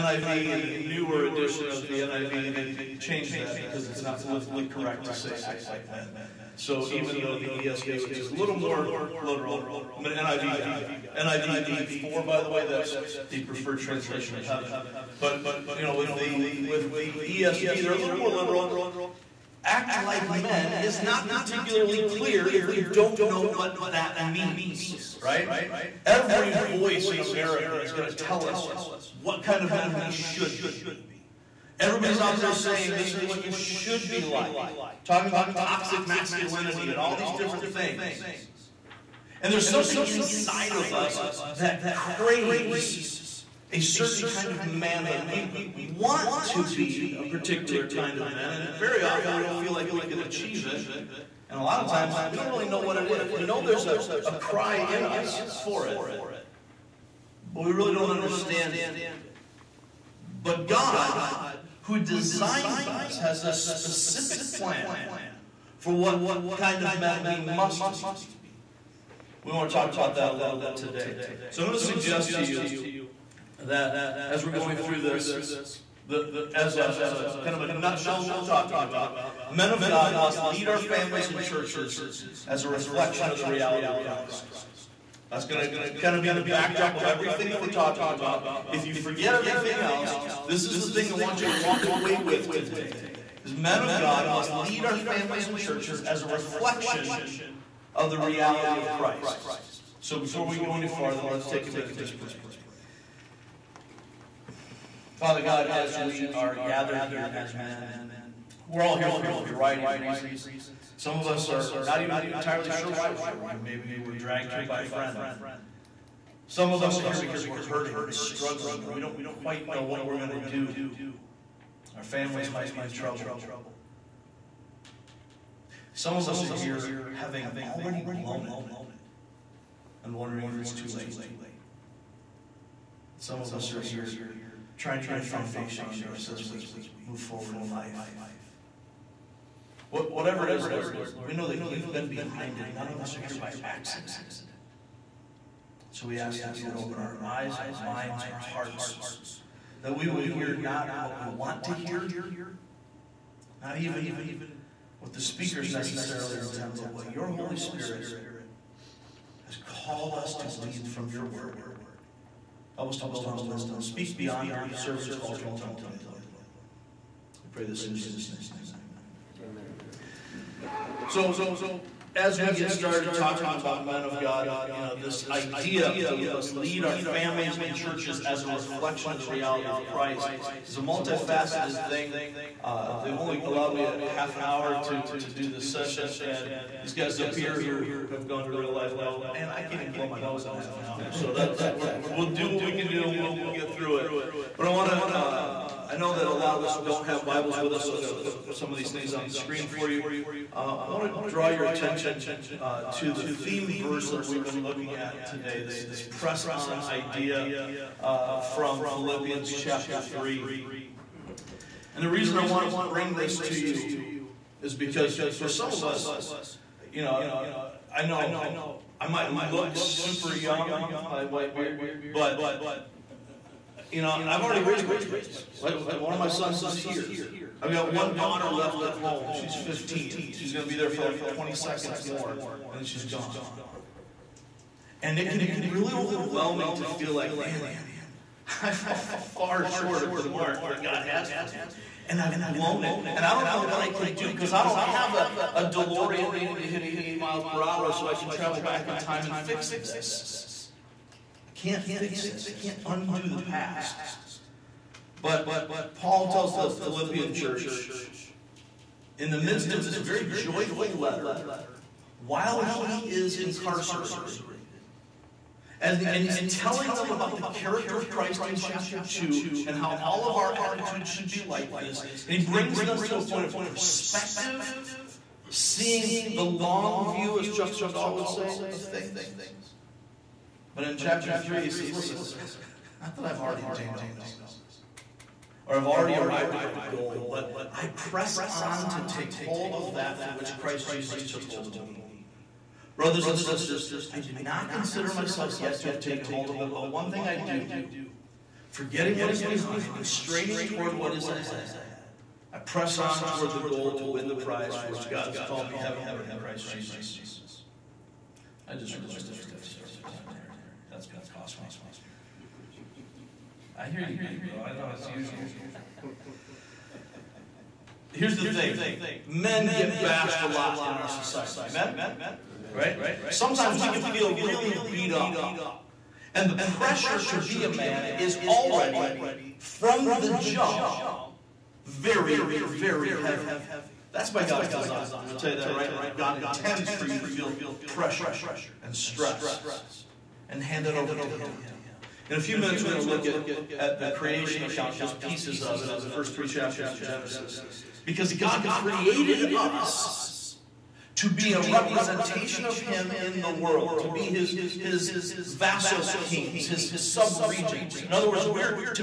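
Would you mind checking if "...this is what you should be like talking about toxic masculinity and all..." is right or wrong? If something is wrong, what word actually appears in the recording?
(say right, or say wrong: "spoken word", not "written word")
right.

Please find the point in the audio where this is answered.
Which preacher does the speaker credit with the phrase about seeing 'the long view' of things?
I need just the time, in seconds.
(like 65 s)
277 s.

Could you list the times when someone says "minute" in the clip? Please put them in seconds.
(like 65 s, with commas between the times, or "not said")
101 s, 342 s.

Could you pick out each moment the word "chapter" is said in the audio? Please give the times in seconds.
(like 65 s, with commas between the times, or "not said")
209 s, 268 s, 280 s, 346 s.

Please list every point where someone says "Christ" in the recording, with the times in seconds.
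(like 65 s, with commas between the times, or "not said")
84 s, 98 s, 179 s, 268 s, 290 s, 306 s.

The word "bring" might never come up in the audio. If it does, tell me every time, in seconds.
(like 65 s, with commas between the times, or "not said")
212 s, 272 s.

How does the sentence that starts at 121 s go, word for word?
Our families might be in trouble.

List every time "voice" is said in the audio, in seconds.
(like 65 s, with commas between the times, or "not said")
26 s.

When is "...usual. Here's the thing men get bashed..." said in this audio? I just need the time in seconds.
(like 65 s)
315 s.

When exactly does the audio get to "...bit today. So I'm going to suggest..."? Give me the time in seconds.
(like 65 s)
70 s.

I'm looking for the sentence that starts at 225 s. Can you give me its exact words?
One of my sons is here I've got one daughter left at home.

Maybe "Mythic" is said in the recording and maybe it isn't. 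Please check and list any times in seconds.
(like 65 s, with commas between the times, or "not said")
not said.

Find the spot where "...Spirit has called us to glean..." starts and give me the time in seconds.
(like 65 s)
157 s.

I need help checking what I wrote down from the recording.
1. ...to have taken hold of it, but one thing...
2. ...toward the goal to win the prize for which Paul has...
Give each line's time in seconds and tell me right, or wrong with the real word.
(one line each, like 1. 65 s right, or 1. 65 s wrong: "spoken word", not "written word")
1. 295 s right
2. 303 s wrong: "God", not "Paul".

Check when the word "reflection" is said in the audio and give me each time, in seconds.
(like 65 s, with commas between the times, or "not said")
82 s, 96 s, 178 s.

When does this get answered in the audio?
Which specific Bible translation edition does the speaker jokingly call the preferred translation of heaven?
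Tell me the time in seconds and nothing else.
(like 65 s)
11 s.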